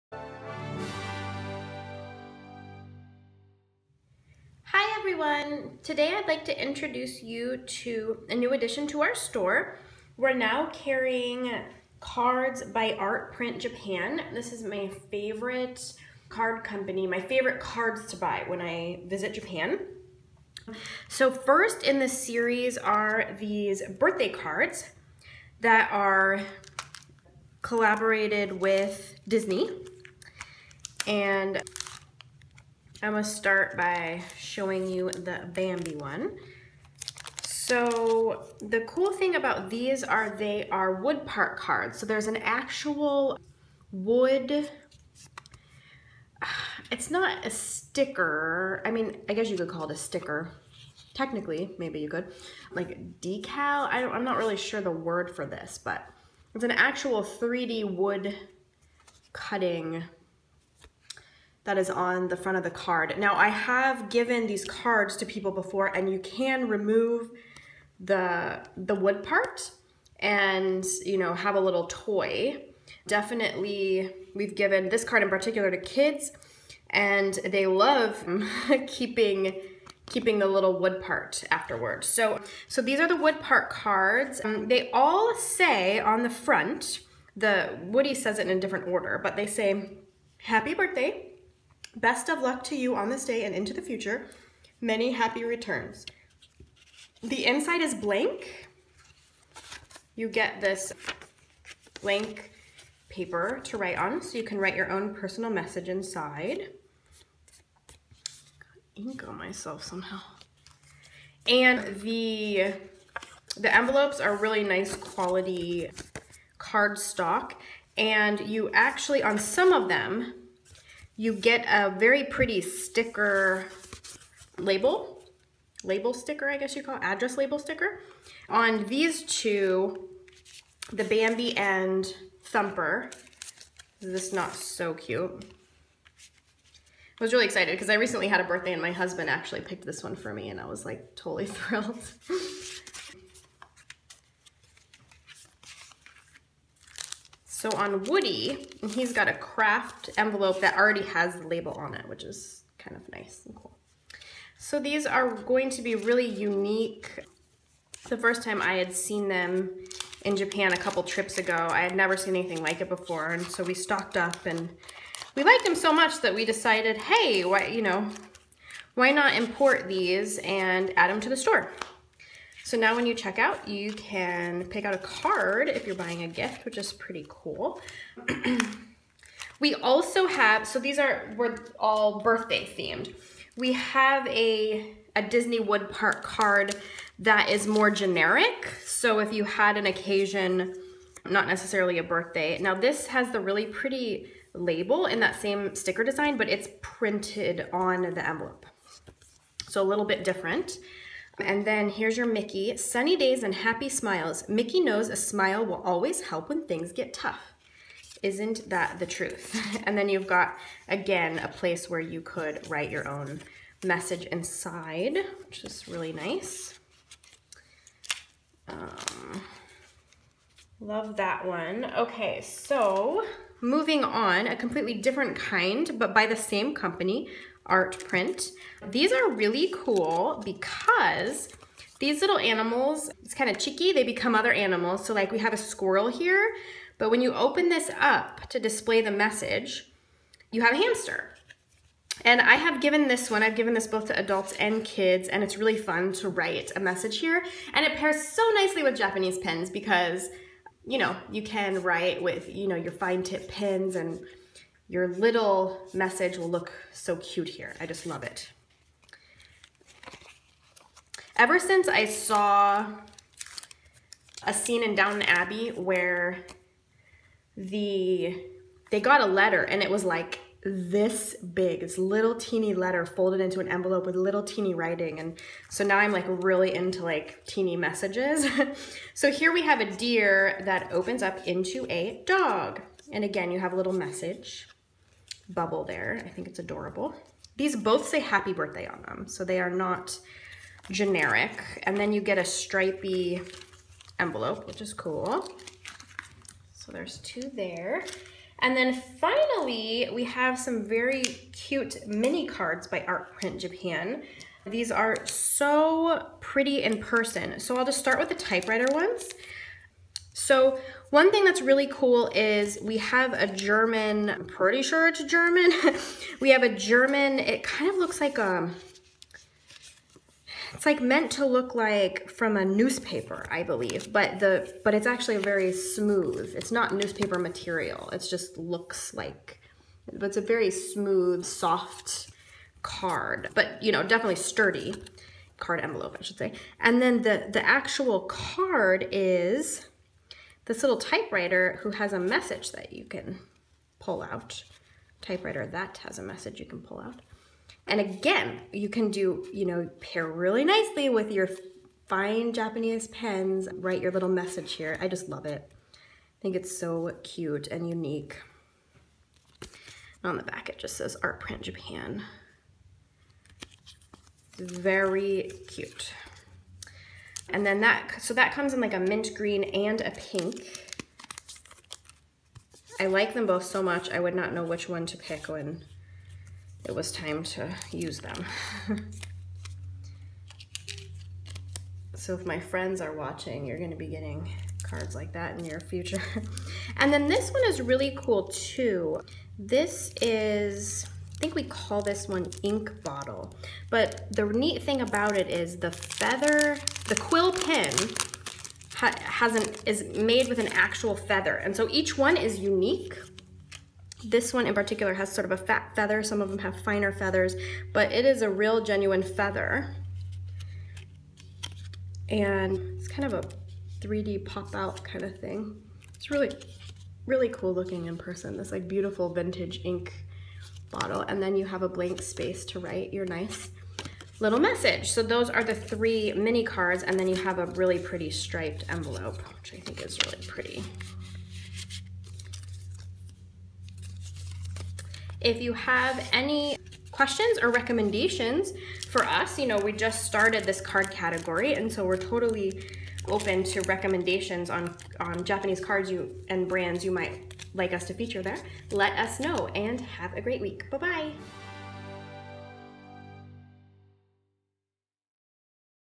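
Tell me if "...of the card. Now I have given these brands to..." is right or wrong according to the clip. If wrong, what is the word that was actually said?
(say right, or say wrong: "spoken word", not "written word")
wrong: "cards", not "brands".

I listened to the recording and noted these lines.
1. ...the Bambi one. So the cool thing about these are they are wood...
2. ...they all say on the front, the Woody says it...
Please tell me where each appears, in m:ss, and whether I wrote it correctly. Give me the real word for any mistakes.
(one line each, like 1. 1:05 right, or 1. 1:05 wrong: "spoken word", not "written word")
1. 0:35 right
2. 1:24 right.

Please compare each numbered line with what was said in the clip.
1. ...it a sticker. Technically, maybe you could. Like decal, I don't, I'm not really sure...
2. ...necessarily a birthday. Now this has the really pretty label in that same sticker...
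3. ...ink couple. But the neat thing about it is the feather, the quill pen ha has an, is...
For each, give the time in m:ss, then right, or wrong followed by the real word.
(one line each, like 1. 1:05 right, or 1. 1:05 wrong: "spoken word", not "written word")
1. 0:49 right
2. 3:11 right
3. 6:32 wrong: "bottle", not "couple".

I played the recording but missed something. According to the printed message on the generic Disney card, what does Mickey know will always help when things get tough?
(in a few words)
A smile.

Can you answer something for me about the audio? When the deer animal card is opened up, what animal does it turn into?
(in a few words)
Dog.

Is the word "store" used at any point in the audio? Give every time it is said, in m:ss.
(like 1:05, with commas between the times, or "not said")
0:09, 2:51.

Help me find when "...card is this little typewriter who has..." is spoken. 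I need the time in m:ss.
5:38.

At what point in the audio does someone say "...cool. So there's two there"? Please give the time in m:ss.
4:54.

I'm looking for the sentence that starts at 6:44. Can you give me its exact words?
This one in particular has sort of a fat feather.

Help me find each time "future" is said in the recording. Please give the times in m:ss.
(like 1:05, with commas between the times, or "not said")
1:33, 6:25.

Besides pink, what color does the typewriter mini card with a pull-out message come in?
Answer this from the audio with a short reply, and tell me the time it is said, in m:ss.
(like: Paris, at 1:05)
Mint green, at 6:08.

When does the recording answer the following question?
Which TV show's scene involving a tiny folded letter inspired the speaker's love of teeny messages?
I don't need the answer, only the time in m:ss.
4:24.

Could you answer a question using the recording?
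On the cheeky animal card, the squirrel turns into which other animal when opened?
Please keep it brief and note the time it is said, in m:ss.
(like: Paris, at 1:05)
Hamster, at 4:00.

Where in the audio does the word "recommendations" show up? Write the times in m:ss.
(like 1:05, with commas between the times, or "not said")
7:17, 7:23.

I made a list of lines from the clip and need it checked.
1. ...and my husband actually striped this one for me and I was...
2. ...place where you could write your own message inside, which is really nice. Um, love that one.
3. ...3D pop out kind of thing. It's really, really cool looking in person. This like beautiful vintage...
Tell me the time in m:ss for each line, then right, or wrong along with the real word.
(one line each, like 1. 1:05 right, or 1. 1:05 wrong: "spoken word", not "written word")
1. 2:18 wrong: "picked", not "striped"
2. 3:31 right
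3. 6:54 right.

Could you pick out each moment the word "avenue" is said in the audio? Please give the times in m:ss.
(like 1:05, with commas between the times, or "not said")
not said.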